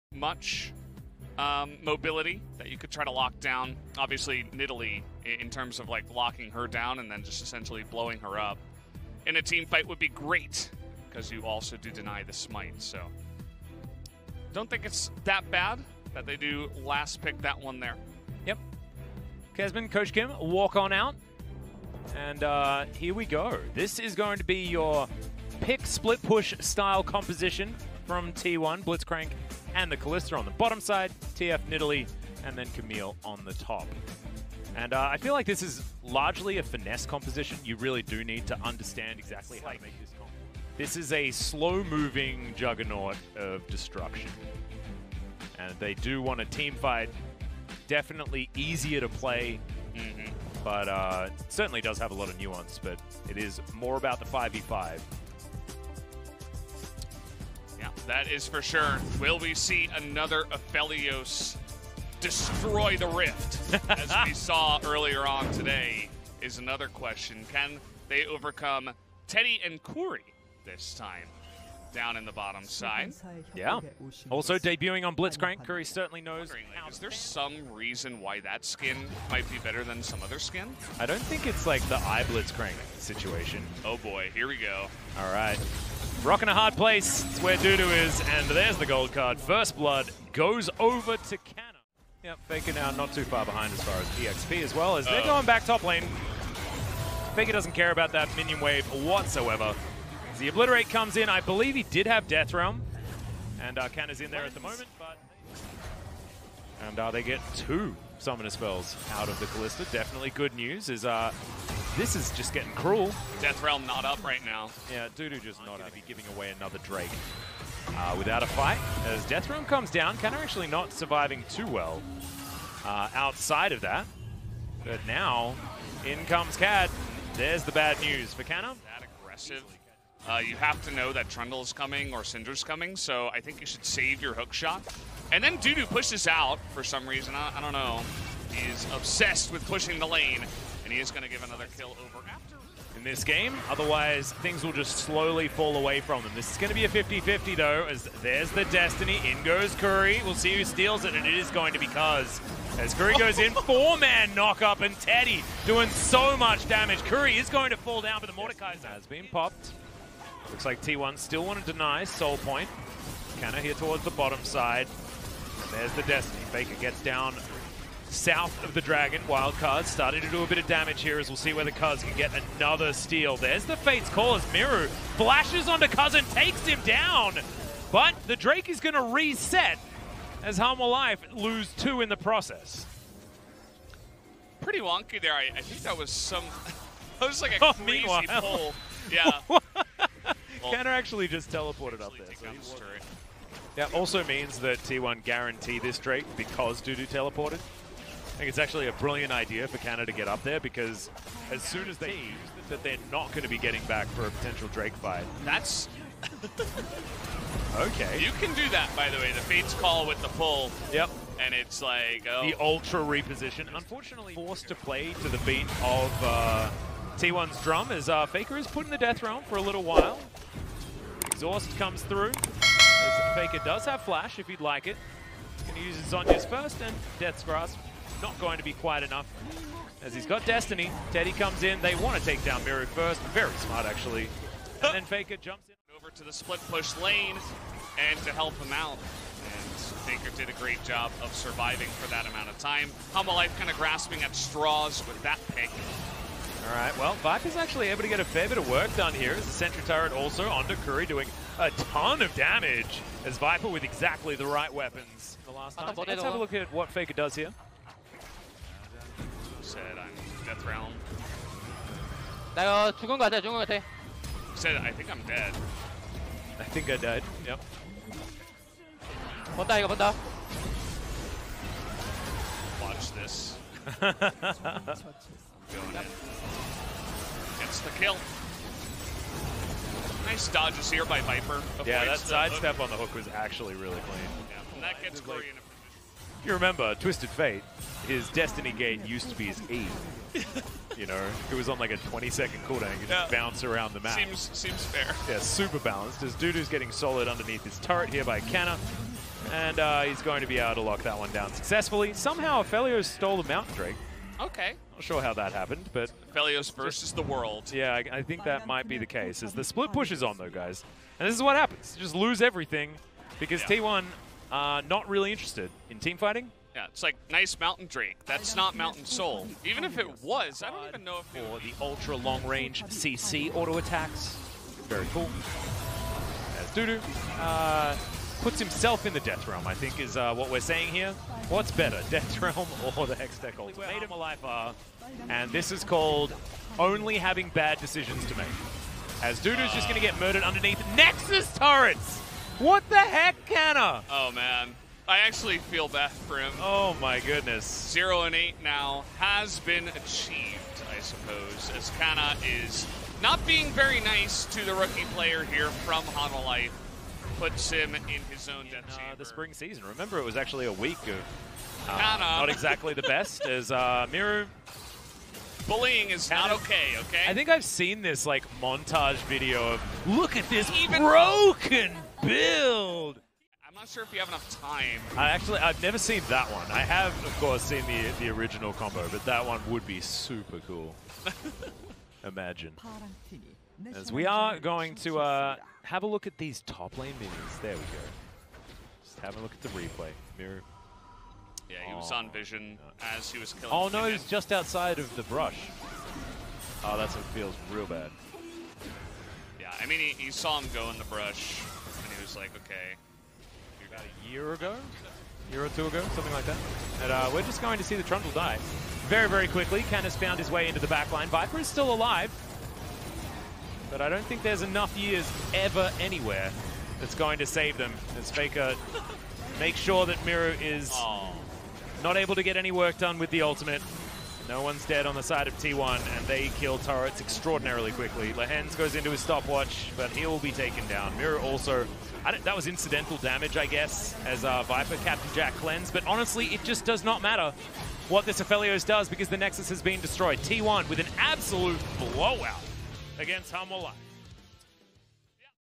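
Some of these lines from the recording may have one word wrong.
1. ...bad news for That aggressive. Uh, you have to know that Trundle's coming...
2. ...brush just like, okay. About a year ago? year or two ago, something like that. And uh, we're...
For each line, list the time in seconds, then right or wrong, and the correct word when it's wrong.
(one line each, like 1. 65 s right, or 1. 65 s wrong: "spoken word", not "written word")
1. 127 s right
2. 401 s right.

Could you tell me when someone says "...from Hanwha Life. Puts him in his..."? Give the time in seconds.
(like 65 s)
355 s.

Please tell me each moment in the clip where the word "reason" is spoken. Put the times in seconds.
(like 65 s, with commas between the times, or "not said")
77 s, 137 s.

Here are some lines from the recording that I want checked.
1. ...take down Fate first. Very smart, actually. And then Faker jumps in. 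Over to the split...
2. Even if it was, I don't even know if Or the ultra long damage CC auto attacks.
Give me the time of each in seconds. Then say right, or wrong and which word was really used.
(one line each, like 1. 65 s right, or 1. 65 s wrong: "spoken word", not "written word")
1. 232 s wrong: "Miru", not "Fate"
2. 319 s wrong: "range", not "damage".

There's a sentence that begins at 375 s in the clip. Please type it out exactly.
I actually, I've never seen that one.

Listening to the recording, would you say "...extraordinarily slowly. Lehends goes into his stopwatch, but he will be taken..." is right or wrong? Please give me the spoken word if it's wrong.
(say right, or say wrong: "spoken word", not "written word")
wrong: "quickly", not "slowly".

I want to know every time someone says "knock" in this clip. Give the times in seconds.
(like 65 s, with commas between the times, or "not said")
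154 s.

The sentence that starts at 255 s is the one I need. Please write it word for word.
Let's have a look at what Faker does here said I'm Death Realm.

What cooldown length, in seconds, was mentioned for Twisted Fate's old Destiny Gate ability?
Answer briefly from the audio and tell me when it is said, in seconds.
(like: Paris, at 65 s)
20 seconds, at 291 s.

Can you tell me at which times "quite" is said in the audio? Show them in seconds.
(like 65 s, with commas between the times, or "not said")
228 s.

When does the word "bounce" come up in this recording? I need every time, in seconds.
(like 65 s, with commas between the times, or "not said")
293 s.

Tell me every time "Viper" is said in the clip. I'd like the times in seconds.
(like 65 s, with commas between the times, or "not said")
247 s, 253 s, 281 s, 411 s, 434 s.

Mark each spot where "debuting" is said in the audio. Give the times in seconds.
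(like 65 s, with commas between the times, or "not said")
74 s.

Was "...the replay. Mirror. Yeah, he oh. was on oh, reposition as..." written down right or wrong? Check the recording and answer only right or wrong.
wrong.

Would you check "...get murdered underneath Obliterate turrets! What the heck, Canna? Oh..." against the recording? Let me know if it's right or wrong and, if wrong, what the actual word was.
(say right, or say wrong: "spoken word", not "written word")
wrong: "Nexus", not "Obliterate".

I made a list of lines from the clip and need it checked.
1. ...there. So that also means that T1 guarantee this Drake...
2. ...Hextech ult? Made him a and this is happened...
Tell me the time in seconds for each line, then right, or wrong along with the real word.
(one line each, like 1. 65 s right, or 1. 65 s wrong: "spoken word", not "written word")
1. 192 s right
2. 333 s wrong: "called", not "happened".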